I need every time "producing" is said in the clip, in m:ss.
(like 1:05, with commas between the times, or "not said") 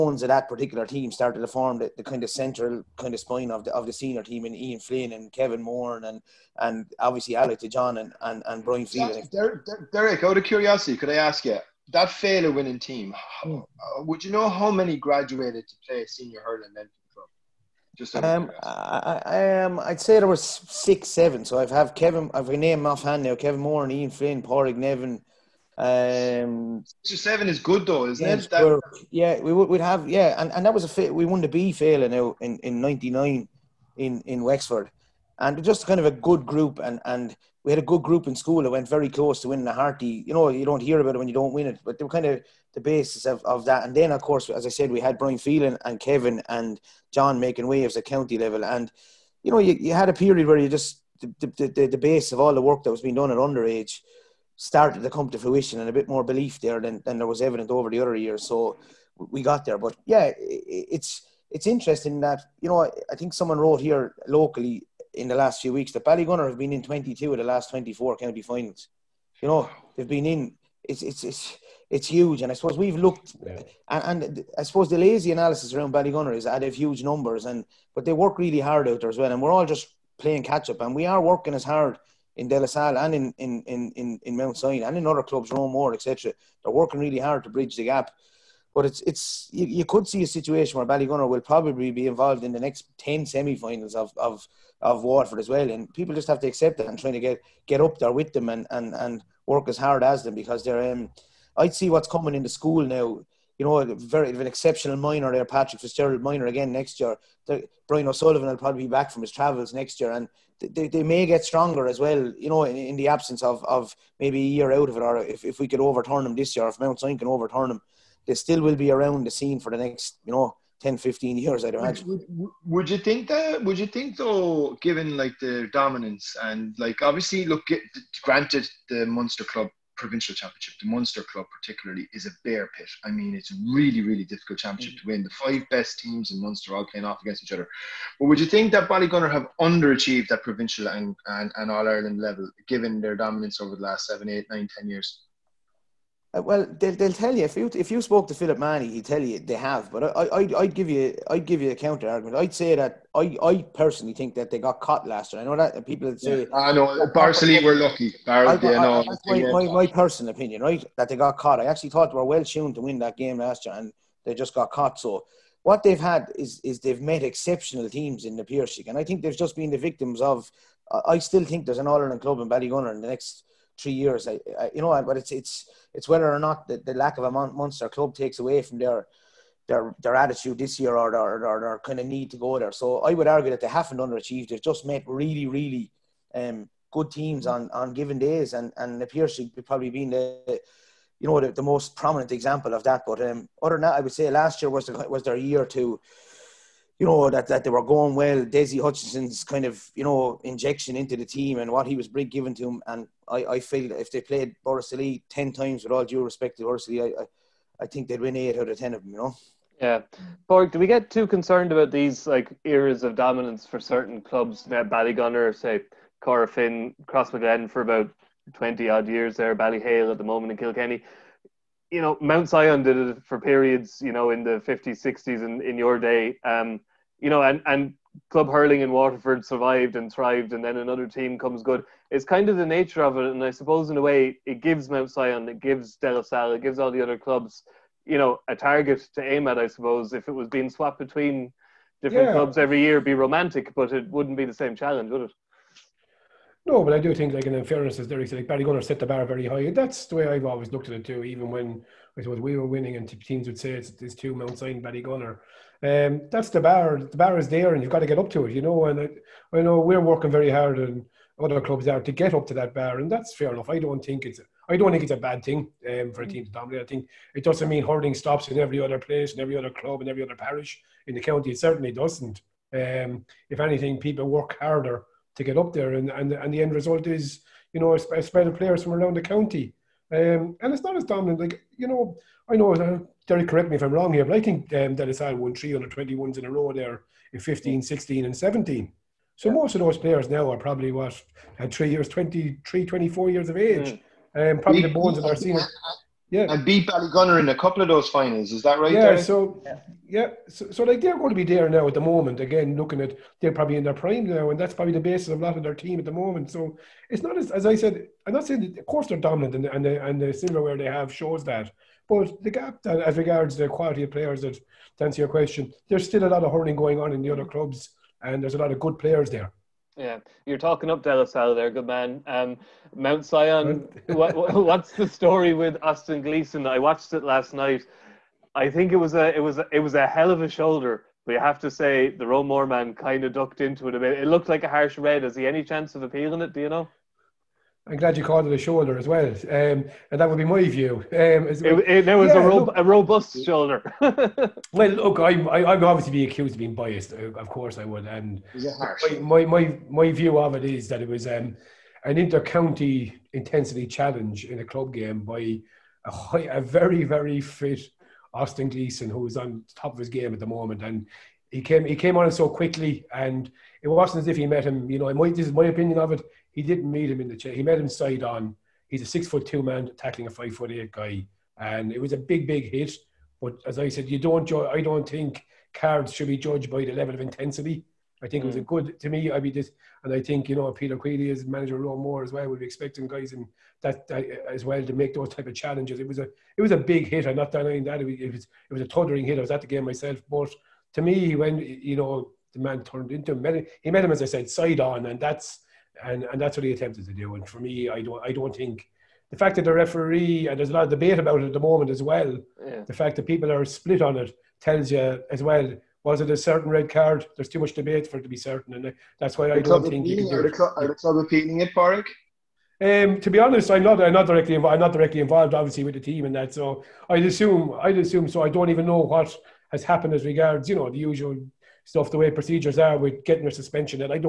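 not said.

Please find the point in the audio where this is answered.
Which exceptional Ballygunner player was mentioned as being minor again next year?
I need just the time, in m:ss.
1:45.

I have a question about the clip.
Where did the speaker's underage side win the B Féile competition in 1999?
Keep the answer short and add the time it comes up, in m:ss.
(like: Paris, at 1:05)
Wexford, at 0:34.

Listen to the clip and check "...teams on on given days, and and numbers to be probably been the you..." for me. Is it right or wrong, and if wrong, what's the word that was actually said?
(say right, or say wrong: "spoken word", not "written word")
wrong: "appears", not "numbers".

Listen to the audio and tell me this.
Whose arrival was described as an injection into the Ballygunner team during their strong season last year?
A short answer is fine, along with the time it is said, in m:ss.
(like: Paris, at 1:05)
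Dessie Hutchinson, at 3:18.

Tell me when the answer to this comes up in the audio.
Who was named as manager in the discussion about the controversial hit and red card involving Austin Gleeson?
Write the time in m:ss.
6:20.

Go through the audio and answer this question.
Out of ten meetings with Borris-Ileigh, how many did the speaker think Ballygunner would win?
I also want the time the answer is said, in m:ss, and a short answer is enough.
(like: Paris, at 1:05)
8, at 3:28.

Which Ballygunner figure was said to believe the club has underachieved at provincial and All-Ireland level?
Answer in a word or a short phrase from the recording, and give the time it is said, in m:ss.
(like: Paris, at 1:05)
Philip Mahony, at 2:28.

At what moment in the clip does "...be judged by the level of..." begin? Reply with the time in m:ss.
6:16.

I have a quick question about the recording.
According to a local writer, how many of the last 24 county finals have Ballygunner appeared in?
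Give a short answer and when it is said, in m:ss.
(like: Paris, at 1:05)
22, at 1:06.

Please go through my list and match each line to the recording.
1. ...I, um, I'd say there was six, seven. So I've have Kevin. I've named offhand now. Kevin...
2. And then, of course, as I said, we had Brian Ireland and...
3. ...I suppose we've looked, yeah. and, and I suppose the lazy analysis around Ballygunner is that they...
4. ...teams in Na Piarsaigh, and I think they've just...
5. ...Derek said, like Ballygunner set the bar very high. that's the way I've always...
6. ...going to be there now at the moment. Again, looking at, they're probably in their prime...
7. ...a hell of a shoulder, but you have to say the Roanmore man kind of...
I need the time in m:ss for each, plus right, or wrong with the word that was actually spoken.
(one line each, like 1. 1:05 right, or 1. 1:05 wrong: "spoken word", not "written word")
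1. 0:19 right
2. 0:43 wrong: "Phelan", not "Ireland"
3. 1:12 right
4. 2:47 right
5. 4:08 right
6. 5:01 right
7. 5:29 right.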